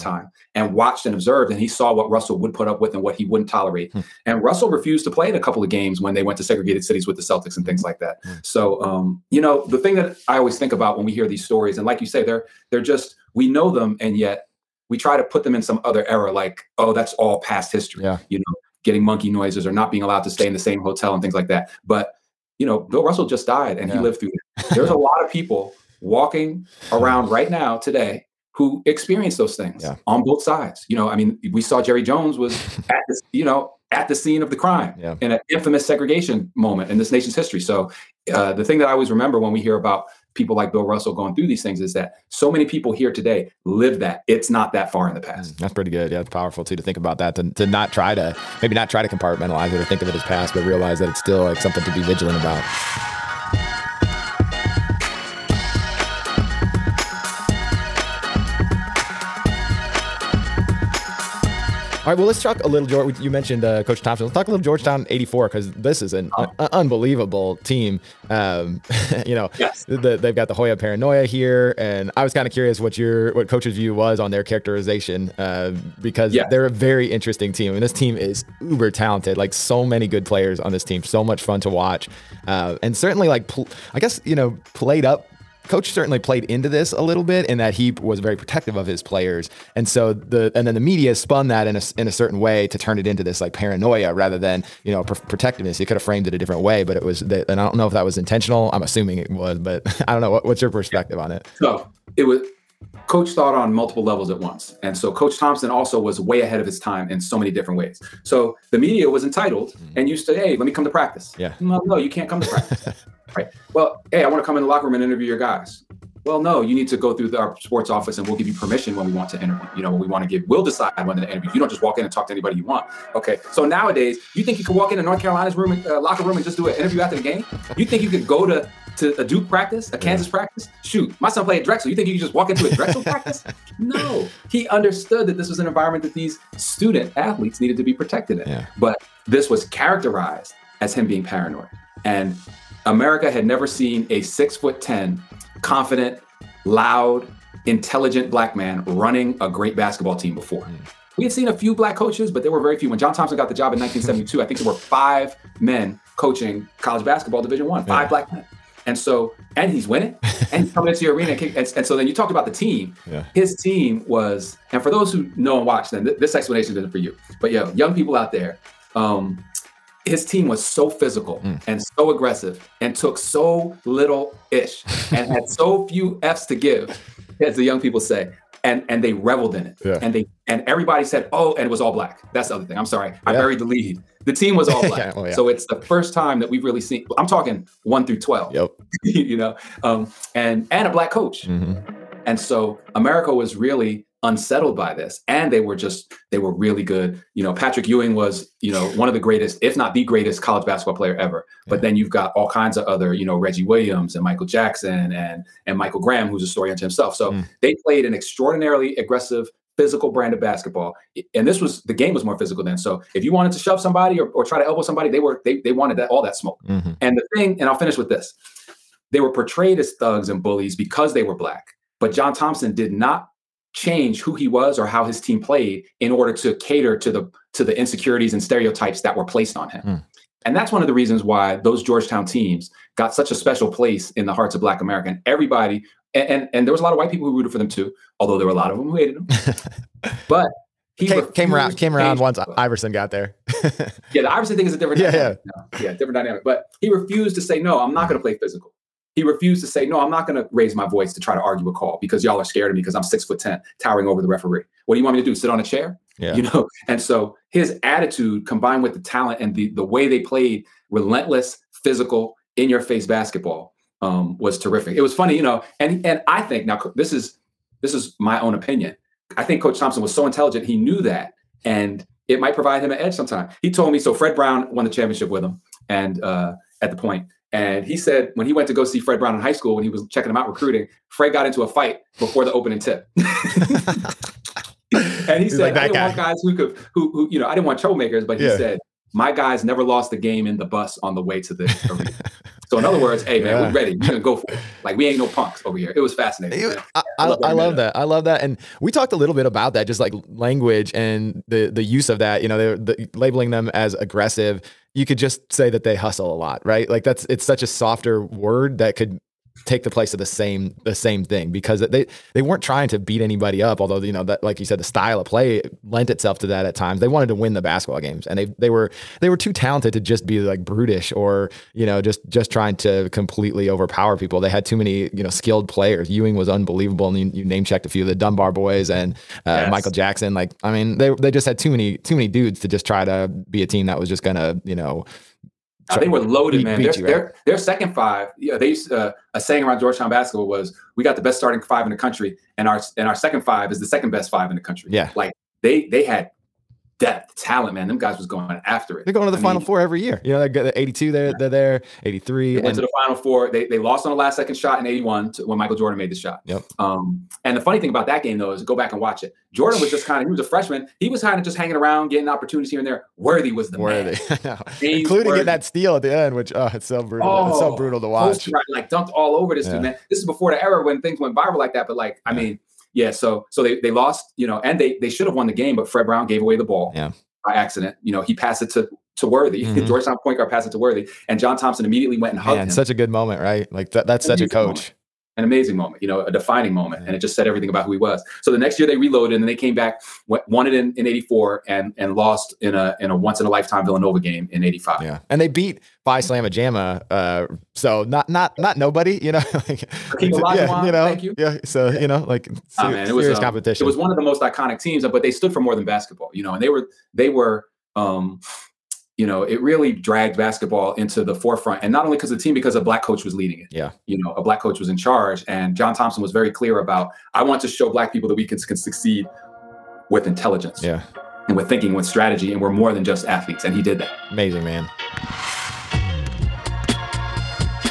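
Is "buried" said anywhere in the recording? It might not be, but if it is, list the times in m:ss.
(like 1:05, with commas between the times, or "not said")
3:03.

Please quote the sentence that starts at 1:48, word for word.
So the media was entitled mm.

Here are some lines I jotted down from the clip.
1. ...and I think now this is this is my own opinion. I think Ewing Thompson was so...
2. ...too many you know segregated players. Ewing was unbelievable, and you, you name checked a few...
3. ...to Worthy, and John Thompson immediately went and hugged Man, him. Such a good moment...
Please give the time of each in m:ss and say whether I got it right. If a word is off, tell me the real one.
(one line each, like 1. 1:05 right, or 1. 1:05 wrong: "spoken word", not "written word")
1. 4:26 wrong: "Coach", not "Ewing"
2. 5:24 wrong: "skilled", not "segregated"
3. 6:20 right.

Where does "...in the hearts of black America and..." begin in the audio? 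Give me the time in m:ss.
3:54.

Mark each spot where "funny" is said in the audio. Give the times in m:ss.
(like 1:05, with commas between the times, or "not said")
4:25, 5:57.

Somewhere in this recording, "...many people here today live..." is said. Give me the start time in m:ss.
0:42.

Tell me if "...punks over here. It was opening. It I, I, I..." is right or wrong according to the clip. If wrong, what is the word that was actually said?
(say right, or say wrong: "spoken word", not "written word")
wrong: "fascinating", not "opening".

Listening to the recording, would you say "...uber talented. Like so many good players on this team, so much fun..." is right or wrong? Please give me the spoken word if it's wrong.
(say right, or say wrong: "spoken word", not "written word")
right.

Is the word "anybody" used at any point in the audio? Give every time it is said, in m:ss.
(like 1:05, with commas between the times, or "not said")
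2:02, 5:13.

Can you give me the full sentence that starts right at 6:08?
Right, like dunked all over this yeah.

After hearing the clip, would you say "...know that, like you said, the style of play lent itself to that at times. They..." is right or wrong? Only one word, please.
right.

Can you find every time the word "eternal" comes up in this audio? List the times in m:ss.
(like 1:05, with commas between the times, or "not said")
not said.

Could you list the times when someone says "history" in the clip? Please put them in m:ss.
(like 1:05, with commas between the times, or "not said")
0:17, 0:37.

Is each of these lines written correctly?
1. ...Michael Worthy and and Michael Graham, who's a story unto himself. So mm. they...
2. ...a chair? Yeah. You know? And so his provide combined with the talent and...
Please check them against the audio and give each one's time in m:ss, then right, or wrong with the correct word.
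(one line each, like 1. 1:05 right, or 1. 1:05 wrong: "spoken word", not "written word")
1. 3:24 wrong: "Jackson", not "Worthy"
2. 4:15 wrong: "attitude", not "provide".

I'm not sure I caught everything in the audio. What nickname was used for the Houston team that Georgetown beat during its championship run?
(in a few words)
Phi Slamma Jamma.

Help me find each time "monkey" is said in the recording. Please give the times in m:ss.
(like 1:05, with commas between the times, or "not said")
0:19.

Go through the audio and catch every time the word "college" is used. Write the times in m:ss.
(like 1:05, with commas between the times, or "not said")
2:36, 3:20.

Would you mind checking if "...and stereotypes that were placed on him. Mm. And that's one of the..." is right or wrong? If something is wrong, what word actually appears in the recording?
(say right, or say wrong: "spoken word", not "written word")
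right.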